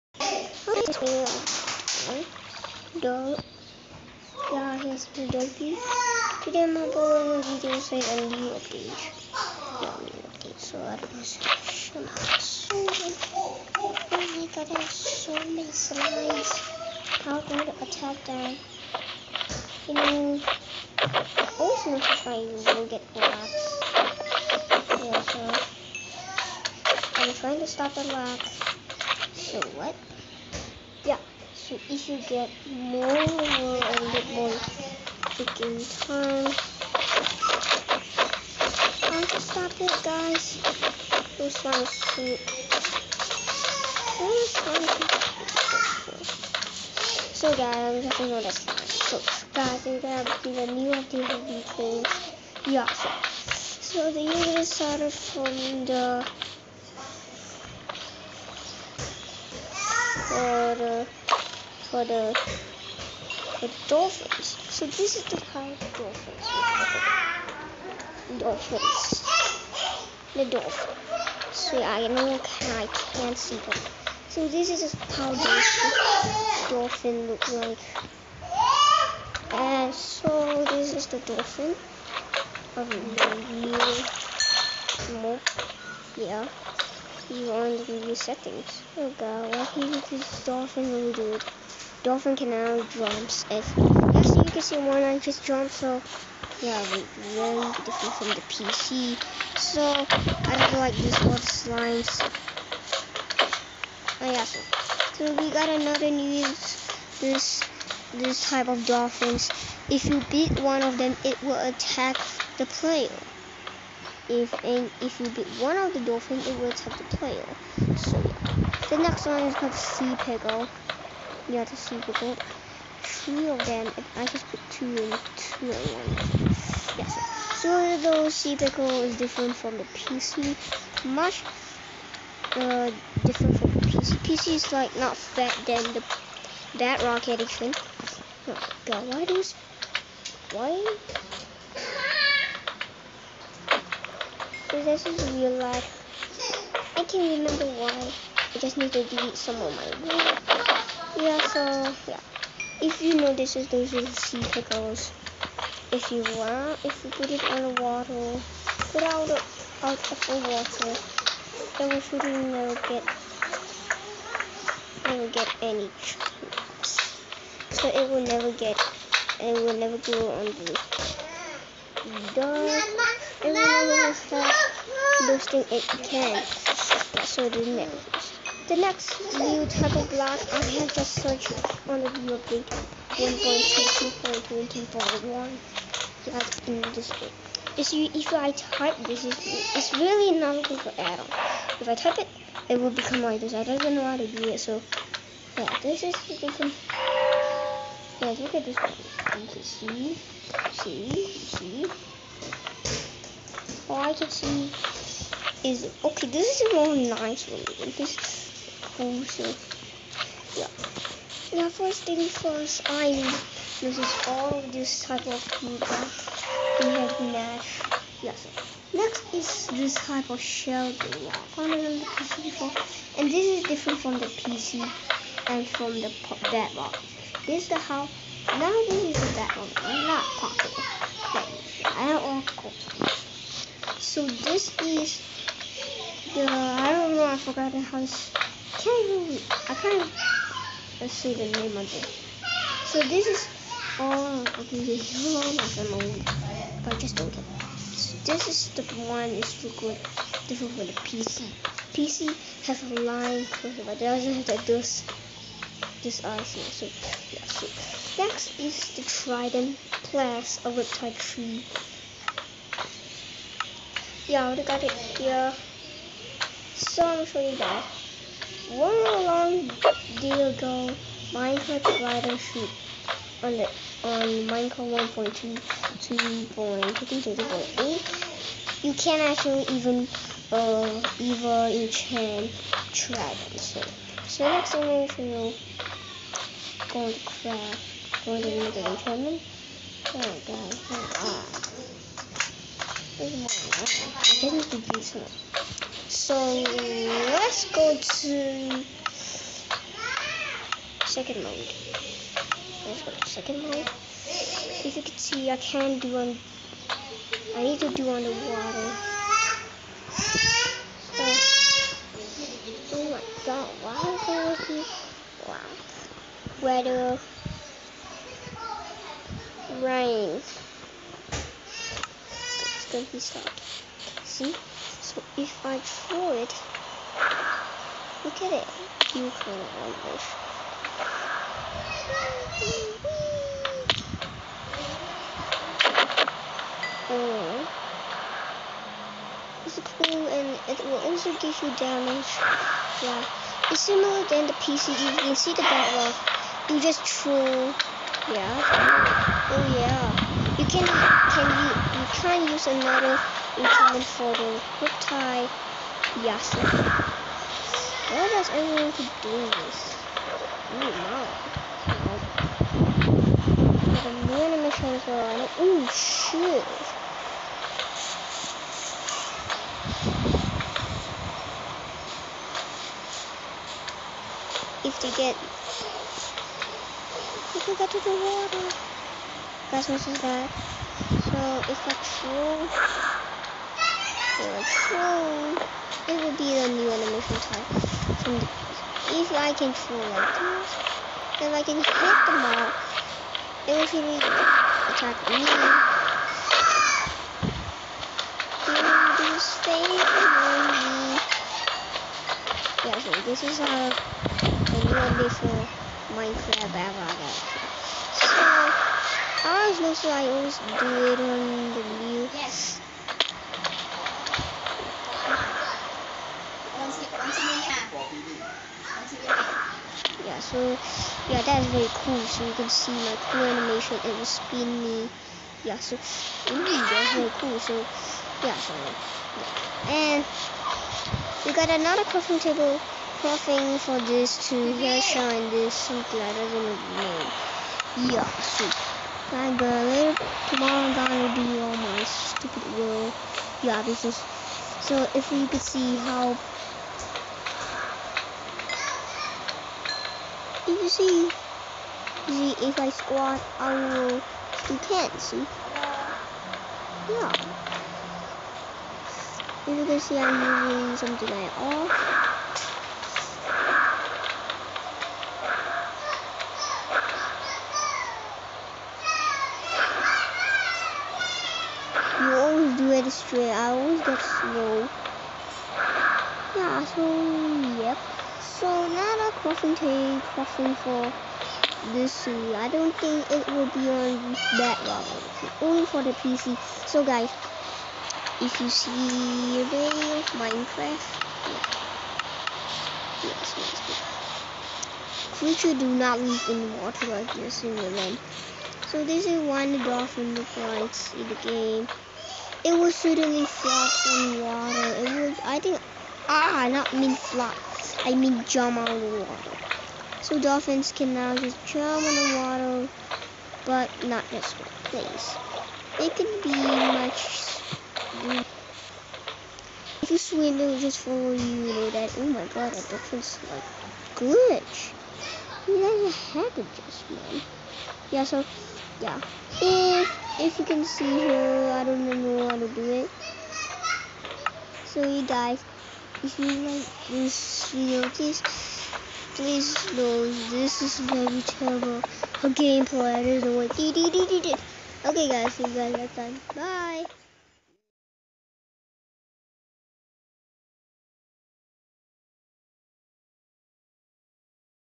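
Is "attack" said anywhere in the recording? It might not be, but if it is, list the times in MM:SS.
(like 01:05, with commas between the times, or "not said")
00:17, 01:51, 01:56, 06:34.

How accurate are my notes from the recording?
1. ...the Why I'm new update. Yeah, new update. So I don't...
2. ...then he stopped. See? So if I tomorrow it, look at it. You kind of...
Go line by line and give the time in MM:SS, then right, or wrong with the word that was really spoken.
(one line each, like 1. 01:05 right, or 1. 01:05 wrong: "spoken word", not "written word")
1. 00:05 wrong: "Today", not "Why"
2. 05:22 wrong: "throw", not "tomorrow".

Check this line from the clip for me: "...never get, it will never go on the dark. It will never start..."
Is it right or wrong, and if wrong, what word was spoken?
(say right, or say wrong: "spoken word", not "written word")
right.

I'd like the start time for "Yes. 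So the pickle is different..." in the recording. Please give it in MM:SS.
02:06.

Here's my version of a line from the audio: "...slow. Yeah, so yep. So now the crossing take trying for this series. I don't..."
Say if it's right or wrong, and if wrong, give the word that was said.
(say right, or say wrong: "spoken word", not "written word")
wrong: "crossing", not "trying".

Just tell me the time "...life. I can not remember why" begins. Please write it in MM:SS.
02:25.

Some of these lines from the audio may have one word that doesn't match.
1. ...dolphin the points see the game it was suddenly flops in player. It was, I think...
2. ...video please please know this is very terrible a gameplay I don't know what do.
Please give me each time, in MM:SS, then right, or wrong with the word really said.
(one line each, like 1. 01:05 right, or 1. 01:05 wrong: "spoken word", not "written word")
1. 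08:19 wrong: "water", not "player"
2. 08:57 right.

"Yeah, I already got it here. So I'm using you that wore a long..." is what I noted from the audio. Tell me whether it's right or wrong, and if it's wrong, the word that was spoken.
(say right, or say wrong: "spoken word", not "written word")
wrong: "showing", not "using".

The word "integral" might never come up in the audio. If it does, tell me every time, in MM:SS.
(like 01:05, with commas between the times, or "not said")
not said.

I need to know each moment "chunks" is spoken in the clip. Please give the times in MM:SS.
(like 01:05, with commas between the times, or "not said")
02:46.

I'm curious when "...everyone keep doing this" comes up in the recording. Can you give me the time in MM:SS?
05:58.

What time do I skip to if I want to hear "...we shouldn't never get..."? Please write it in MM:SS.
02:41.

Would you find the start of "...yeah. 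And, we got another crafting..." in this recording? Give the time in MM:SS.
07:09.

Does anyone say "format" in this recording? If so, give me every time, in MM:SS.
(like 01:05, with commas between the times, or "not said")
not said.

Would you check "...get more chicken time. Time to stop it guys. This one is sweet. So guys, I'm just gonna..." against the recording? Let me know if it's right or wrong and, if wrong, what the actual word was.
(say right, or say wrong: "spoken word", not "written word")
right.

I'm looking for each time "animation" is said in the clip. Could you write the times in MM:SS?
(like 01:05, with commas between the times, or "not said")
06:04, 06:26, 07:03.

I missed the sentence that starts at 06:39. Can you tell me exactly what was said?
Do this yeah, so this is a uh, new do before.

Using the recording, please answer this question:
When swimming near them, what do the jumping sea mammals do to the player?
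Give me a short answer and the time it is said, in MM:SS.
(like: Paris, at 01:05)
Follow you, at 08:40.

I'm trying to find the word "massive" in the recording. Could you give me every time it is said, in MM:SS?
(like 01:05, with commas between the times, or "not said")
not said.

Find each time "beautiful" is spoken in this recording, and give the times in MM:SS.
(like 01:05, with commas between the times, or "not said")
04:54.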